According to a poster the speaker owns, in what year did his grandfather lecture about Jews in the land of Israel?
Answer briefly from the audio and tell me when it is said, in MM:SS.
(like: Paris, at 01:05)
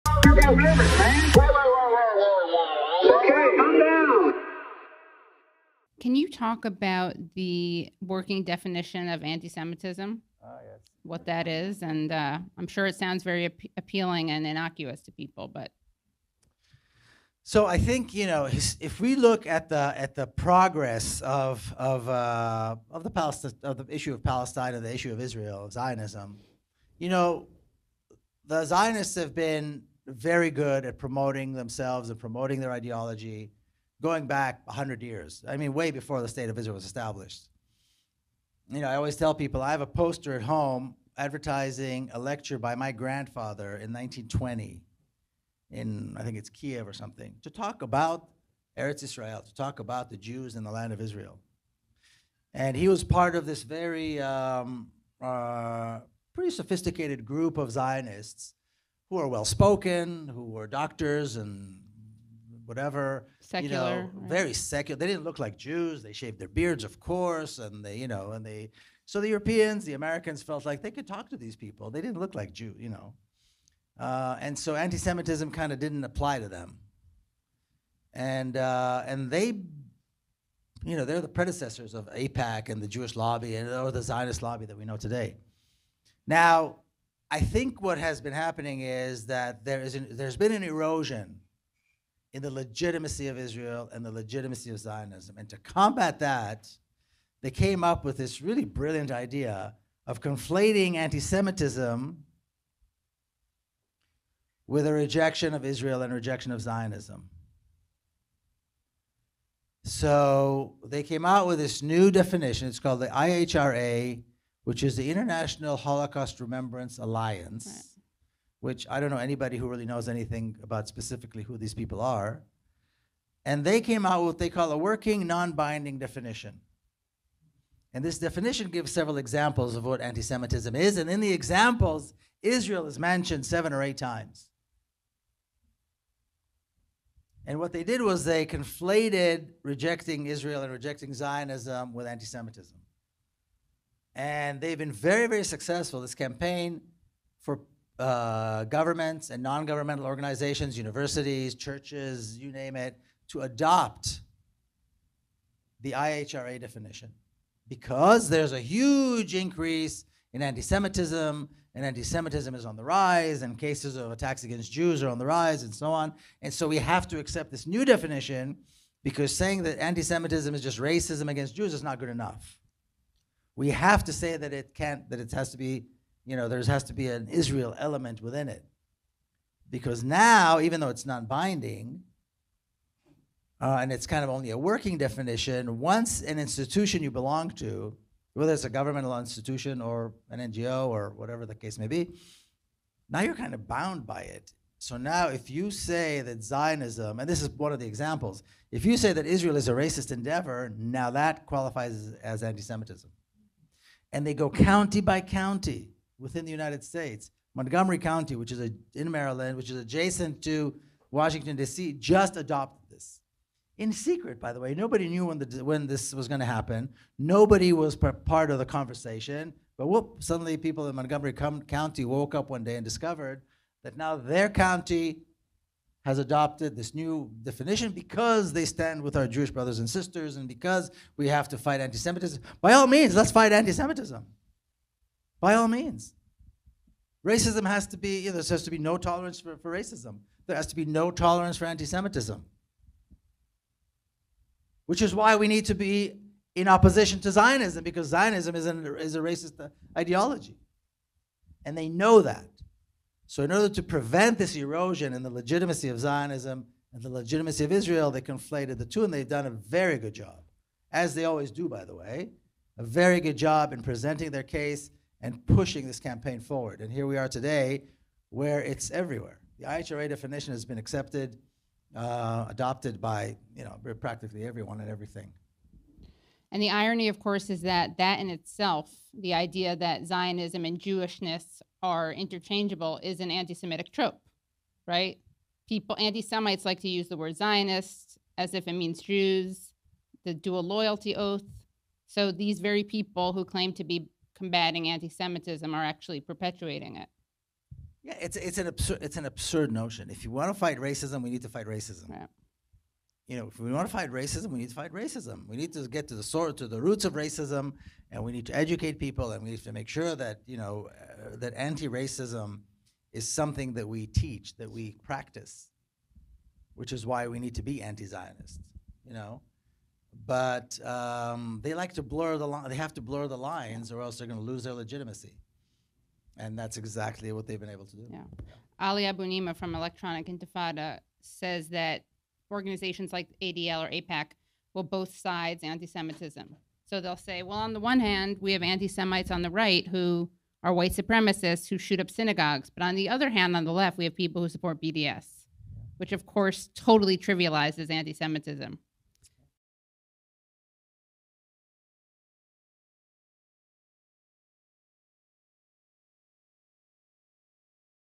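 1920, at 00:43.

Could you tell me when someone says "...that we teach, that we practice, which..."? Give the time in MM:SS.
05:13.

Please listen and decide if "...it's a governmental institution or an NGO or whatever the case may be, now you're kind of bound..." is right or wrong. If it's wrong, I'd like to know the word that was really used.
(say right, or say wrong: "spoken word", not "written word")
right.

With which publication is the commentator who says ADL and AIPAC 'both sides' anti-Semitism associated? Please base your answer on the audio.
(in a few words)
Electronic Intifada.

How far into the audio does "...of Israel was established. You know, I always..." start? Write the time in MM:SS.
00:36.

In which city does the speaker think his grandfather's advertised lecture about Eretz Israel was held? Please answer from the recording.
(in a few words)
Kiev.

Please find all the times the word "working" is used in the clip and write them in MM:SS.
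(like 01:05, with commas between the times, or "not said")
00:08, 02:04, 03:04.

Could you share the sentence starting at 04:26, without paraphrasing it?
And here we are today, where it's everywhere.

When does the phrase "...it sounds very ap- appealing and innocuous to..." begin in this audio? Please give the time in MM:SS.
00:12.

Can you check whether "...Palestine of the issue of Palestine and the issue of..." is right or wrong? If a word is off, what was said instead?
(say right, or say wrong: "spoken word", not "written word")
right.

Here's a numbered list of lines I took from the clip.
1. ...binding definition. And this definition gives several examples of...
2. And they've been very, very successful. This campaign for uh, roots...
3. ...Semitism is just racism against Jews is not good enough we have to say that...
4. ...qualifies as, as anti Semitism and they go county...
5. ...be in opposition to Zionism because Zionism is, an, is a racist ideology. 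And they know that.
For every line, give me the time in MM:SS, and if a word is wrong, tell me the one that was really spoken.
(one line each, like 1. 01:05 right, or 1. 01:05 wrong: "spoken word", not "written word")
1. 02:05 right
2. 02:24 wrong: "governments", not "roots"
3. 02:50 right
4. 03:21 right
5. 04:05 right.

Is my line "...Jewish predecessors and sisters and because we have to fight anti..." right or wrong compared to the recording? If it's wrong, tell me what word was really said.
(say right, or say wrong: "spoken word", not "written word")
wrong: "brothers", not "predecessors".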